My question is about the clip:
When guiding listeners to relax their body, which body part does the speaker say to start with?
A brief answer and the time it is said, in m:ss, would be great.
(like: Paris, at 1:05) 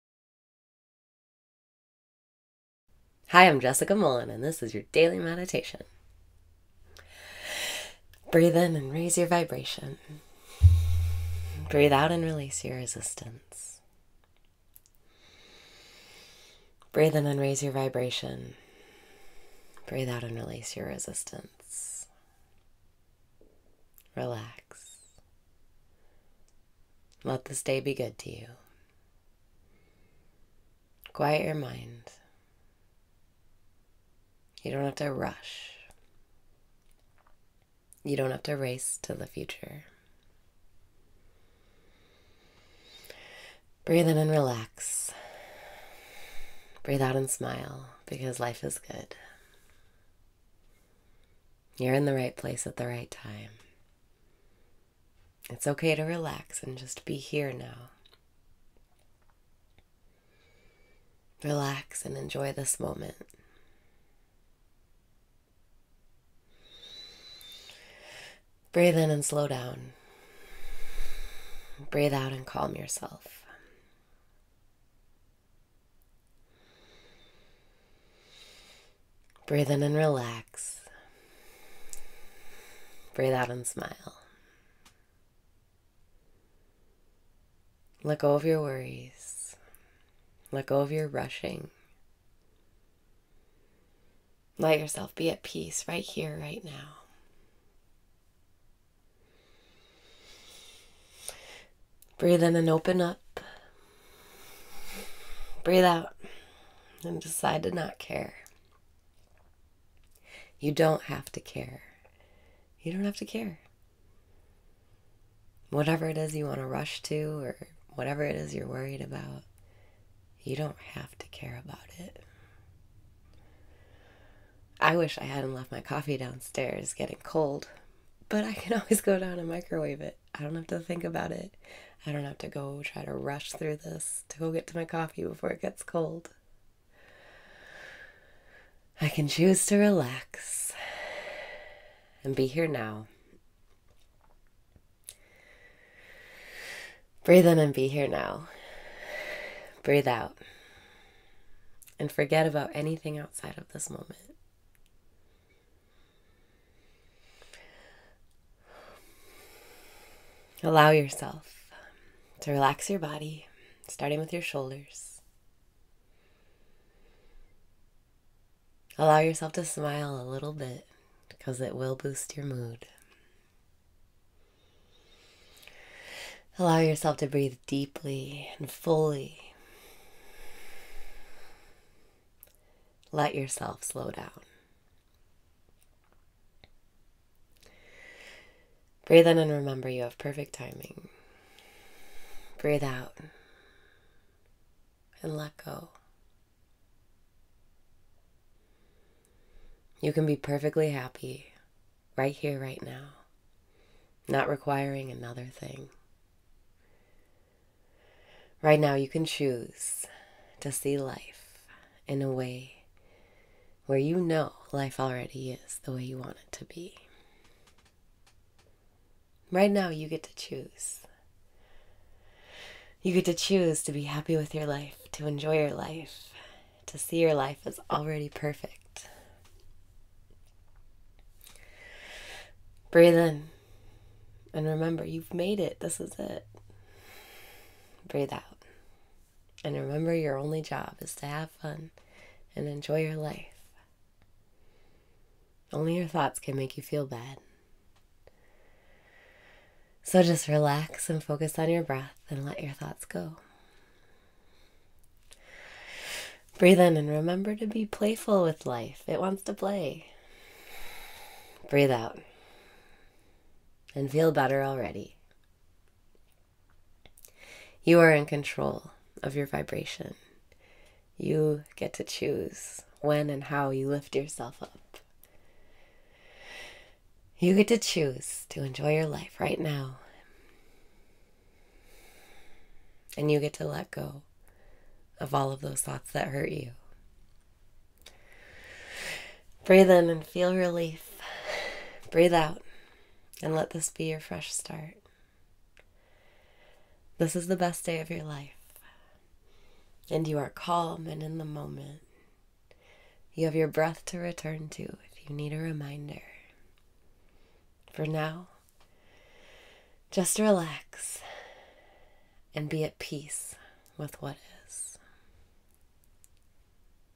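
Shoulders, at 2:44.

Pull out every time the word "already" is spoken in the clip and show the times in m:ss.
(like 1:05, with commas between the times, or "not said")
3:34, 3:47, 4:24.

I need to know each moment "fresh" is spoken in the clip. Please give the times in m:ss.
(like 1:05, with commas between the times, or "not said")
4:54.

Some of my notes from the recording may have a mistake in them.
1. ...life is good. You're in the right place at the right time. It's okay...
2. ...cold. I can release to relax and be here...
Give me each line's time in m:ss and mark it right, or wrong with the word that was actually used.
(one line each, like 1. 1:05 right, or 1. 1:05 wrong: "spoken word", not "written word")
1. 0:48 right
2. 2:15 wrong: "choose", not "release".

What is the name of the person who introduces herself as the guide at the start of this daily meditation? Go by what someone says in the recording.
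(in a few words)
Jessica Mullen.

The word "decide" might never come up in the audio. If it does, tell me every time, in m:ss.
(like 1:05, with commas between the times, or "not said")
1:47.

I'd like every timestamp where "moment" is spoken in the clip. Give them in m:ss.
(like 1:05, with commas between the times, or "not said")
1:02, 2:33, 5:01.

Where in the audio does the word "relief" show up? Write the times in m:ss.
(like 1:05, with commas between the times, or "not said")
4:50.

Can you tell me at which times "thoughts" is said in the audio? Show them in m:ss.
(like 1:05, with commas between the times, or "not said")
4:06, 4:12, 4:45.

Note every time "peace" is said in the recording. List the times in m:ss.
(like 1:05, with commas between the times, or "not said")
1:35, 5:12.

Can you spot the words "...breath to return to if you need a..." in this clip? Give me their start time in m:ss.
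5:03.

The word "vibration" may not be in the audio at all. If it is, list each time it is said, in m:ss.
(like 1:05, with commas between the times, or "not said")
0:09, 0:17, 4:29.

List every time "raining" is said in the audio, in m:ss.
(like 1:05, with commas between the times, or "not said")
not said.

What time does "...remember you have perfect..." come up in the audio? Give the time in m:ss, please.
3:09.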